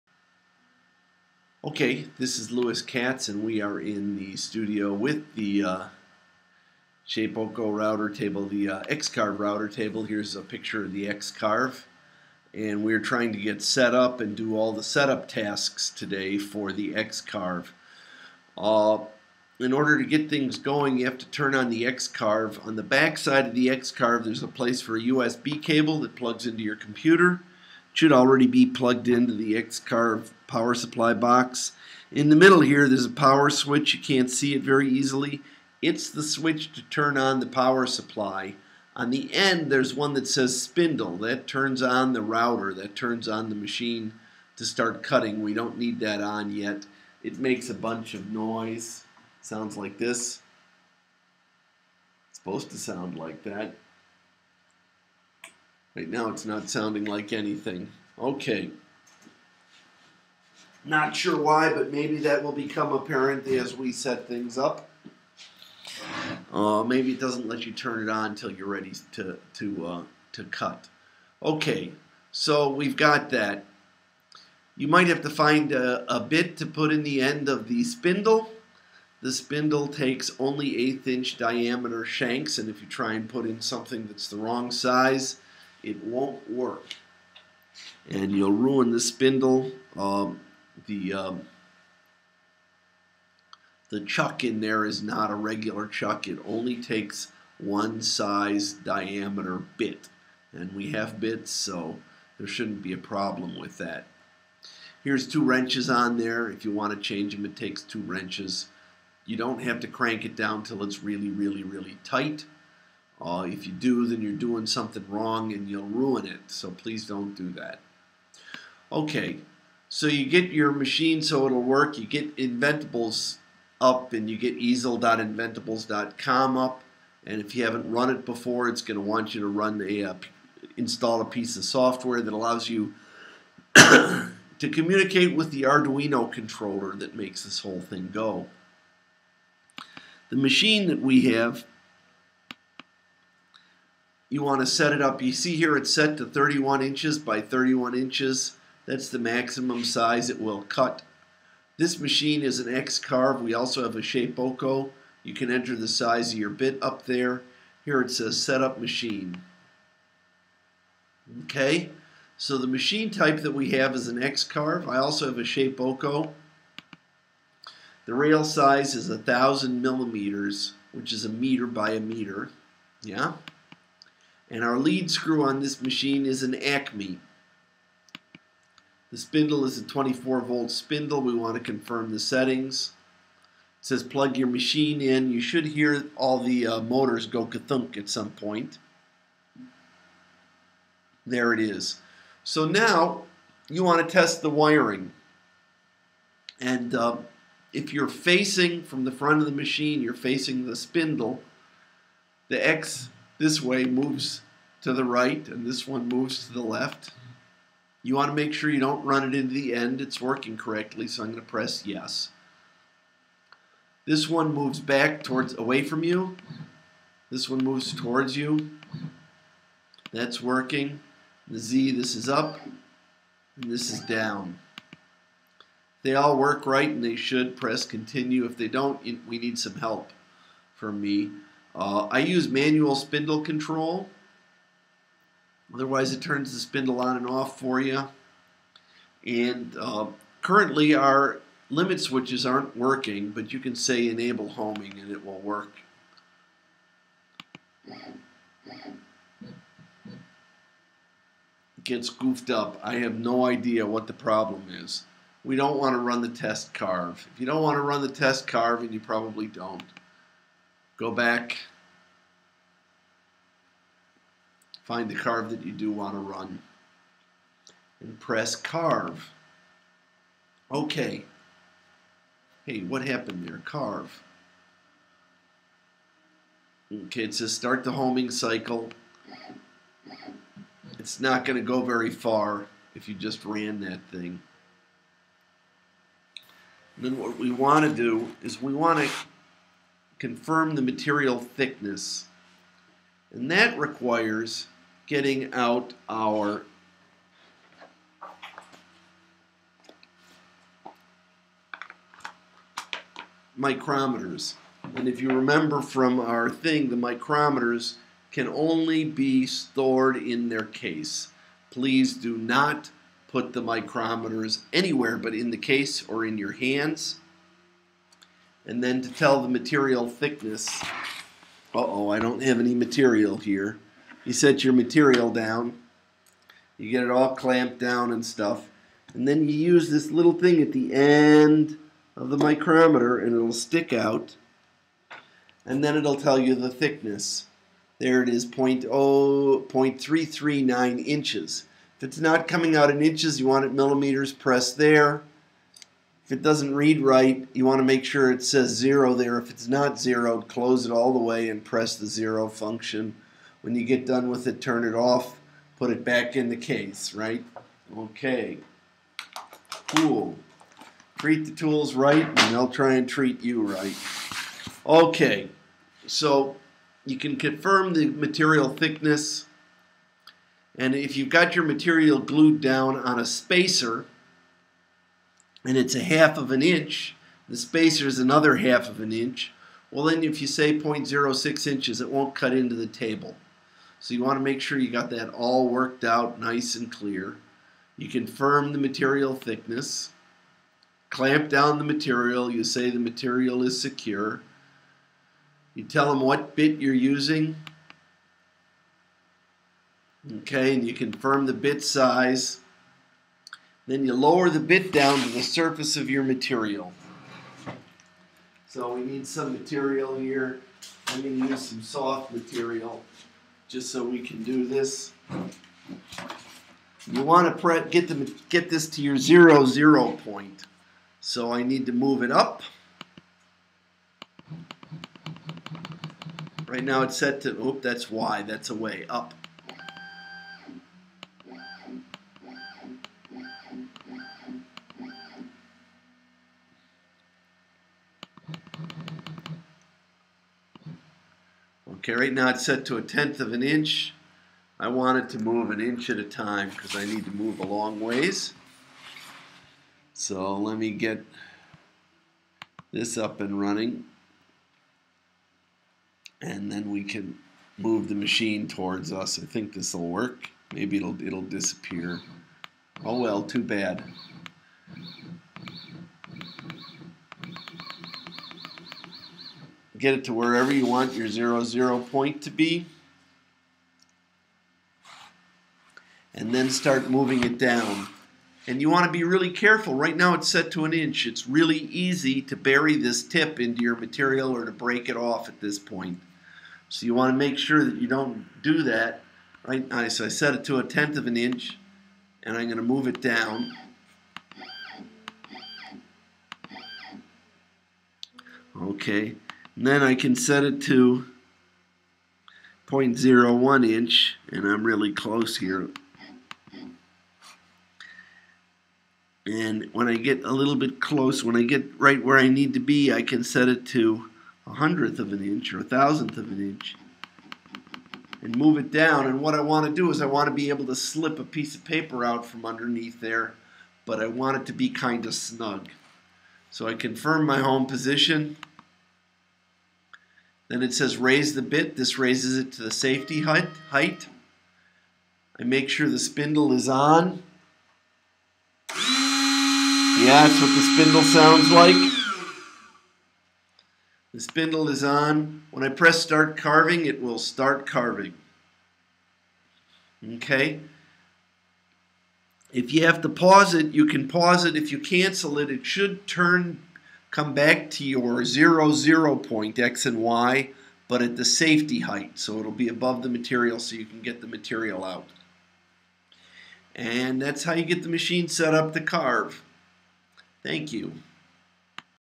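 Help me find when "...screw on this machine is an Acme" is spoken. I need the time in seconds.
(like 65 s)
175 s.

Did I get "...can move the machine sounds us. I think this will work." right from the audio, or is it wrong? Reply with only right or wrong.
wrong.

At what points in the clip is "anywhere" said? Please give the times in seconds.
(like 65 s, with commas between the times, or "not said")
314 s.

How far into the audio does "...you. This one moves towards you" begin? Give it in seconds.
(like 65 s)
216 s.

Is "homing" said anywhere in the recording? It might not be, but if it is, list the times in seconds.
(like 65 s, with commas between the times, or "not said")
244 s, 277 s.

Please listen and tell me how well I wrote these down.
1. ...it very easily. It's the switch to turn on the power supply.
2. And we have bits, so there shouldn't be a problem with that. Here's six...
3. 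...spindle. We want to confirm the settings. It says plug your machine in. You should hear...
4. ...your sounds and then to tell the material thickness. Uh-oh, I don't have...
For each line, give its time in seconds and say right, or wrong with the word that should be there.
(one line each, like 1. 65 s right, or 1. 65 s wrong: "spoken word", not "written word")
1. 34 s right
2. 100 s wrong: "two", not "six"
3. 180 s right
4. 316 s wrong: "hands", not "sounds".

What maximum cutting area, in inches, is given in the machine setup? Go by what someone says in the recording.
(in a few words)
31 by 31 inches.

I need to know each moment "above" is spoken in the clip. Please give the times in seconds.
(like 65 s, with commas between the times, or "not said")
562 s.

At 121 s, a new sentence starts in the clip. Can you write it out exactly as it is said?
You get Inventables up and you get easel.inventables.com up.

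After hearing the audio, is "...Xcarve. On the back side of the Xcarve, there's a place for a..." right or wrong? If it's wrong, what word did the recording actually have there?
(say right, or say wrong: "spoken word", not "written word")
right.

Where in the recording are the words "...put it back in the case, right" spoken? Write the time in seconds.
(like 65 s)
355 s.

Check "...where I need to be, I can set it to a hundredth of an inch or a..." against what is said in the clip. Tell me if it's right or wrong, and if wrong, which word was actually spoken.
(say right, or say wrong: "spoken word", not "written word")
right.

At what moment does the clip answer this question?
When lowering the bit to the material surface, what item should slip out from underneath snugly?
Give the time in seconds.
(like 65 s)
521 s.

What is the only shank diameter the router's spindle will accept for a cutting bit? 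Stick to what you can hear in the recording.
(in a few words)
1/8 inch.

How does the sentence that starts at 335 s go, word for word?
And then it'll tell you the thickness.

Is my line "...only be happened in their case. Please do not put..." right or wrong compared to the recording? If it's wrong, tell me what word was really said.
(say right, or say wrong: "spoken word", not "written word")
wrong: "stored", not "happened".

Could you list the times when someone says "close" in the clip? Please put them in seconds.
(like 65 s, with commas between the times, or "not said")
350 s, 505 s, 511 s.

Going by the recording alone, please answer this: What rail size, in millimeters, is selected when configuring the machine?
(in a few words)
1000 millimeters.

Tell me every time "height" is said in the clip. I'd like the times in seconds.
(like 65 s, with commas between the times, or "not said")
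533 s, 562 s.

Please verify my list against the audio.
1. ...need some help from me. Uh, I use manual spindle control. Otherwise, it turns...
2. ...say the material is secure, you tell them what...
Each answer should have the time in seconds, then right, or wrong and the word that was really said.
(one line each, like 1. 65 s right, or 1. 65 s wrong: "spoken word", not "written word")
1. 229 s right
2. 392 s right.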